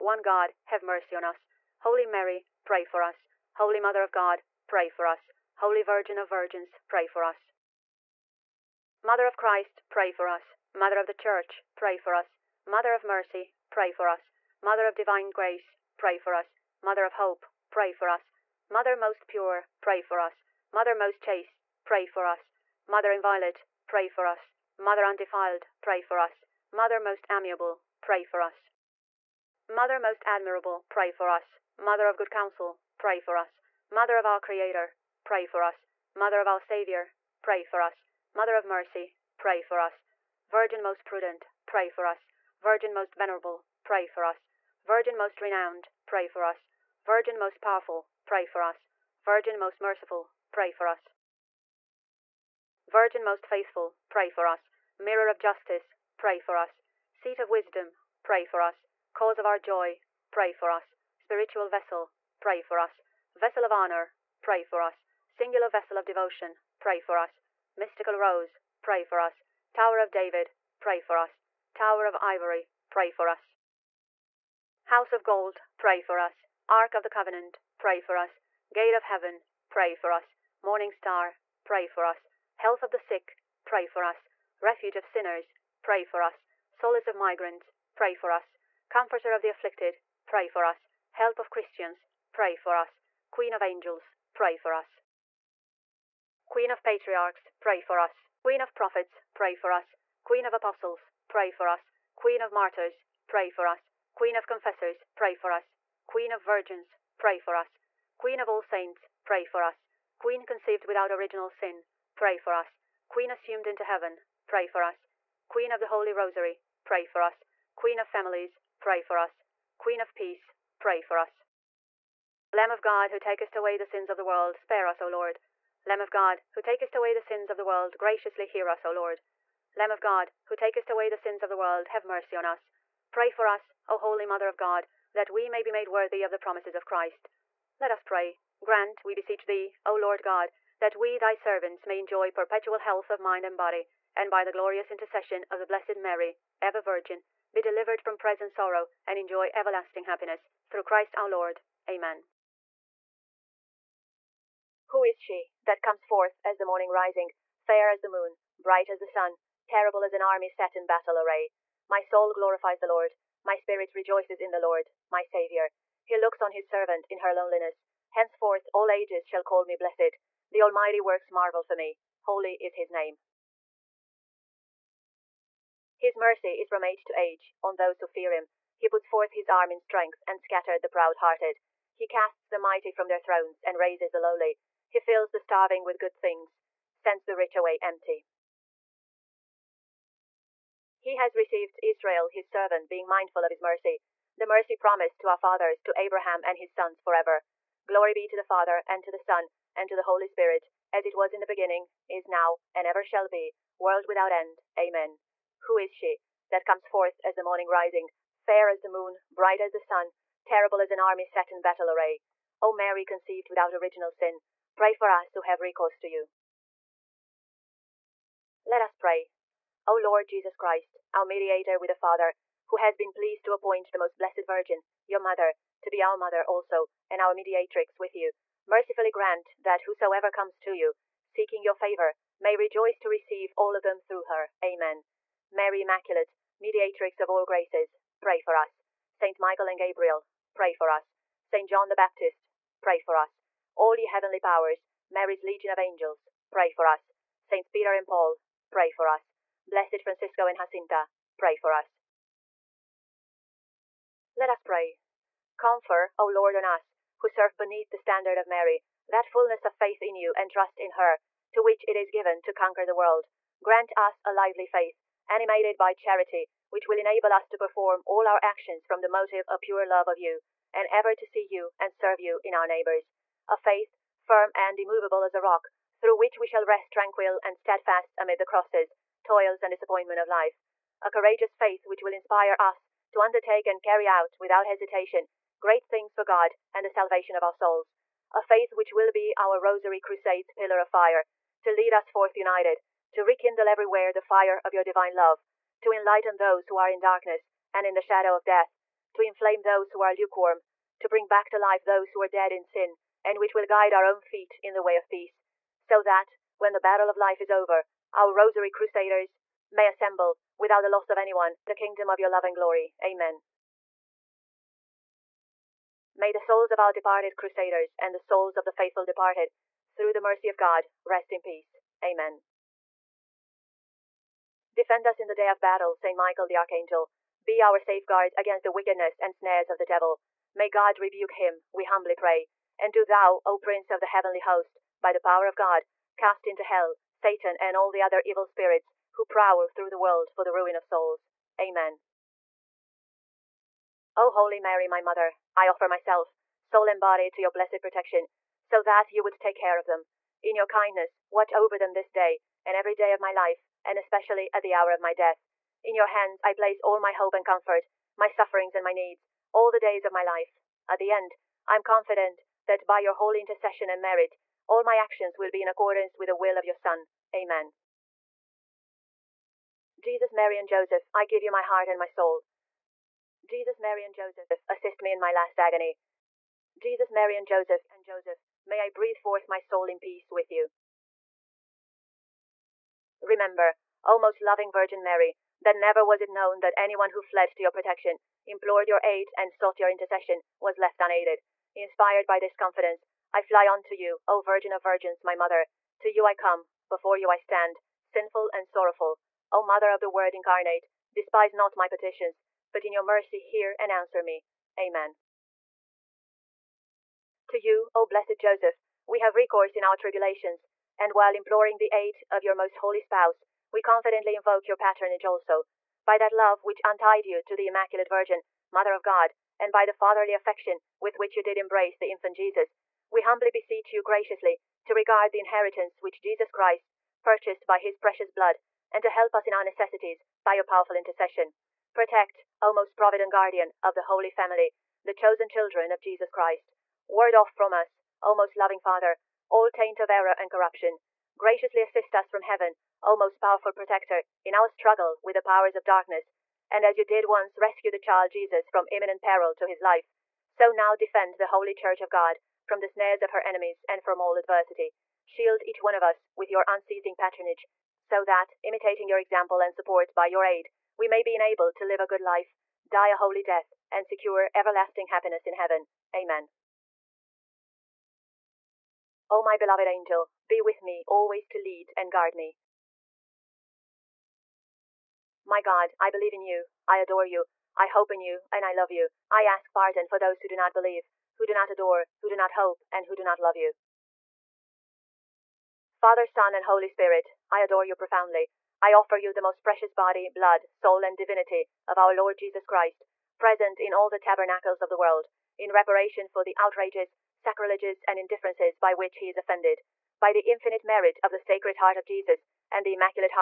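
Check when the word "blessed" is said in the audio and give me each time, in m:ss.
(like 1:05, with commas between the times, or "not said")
2:25, 2:49, 3:44, 4:09, 5:47, 6:48.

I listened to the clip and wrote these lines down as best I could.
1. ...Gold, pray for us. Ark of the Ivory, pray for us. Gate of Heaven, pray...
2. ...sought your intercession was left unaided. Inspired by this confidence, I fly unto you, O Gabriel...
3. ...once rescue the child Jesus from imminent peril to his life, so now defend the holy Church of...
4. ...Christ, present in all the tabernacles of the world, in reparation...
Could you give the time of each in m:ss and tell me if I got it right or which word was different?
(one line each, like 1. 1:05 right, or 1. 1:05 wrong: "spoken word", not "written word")
1. 1:15 wrong: "Covenant", not "Ivory"
2. 6:29 wrong: "Virgin", not "Gabriel"
3. 7:27 right
4. 8:12 right.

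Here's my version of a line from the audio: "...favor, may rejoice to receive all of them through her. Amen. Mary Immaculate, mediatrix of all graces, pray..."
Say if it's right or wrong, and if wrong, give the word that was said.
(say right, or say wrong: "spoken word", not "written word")
right.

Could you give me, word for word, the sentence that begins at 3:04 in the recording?
He fills the starving with good things, sends the rich away empty.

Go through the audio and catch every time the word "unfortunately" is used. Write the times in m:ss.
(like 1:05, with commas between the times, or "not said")
not said.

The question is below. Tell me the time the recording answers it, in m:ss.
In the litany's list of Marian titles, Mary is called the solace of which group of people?
1:27.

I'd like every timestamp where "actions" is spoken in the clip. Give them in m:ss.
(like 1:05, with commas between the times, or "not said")
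4:28, 6:04.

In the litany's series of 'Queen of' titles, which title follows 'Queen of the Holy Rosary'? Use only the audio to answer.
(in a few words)
Queen of families.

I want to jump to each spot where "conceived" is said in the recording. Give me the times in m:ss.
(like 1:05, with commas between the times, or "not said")
1:50, 3:33.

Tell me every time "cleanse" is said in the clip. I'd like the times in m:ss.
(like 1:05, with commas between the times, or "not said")
not said.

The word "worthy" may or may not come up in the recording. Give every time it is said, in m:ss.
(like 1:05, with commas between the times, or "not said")
2:15.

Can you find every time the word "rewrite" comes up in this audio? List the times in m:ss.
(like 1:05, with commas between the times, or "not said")
not said.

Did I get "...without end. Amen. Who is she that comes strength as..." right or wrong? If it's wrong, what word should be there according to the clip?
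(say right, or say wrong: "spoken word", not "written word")
wrong: "forth", not "strength".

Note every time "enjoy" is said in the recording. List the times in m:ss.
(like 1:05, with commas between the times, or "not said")
2:21, 2:29.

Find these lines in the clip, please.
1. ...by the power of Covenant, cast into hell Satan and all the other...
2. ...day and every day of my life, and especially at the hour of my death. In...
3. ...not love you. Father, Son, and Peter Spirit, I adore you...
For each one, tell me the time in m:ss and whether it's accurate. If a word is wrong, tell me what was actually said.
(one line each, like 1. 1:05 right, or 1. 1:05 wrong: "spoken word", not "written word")
1. 5:35 wrong: "God", not "Covenant"
2. 5:52 right
3. 8:03 wrong: "Holy", not "Peter".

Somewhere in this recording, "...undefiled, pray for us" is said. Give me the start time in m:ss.
0:25.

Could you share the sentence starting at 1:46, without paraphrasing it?
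Queen of Virgins, pray for us.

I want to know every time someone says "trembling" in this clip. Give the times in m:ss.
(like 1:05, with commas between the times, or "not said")
not said.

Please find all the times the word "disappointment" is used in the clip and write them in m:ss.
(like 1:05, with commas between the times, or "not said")
4:39.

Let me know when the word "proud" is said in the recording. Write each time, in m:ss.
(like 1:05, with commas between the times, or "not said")
3:00.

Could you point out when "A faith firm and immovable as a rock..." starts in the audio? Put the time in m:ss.
4:33.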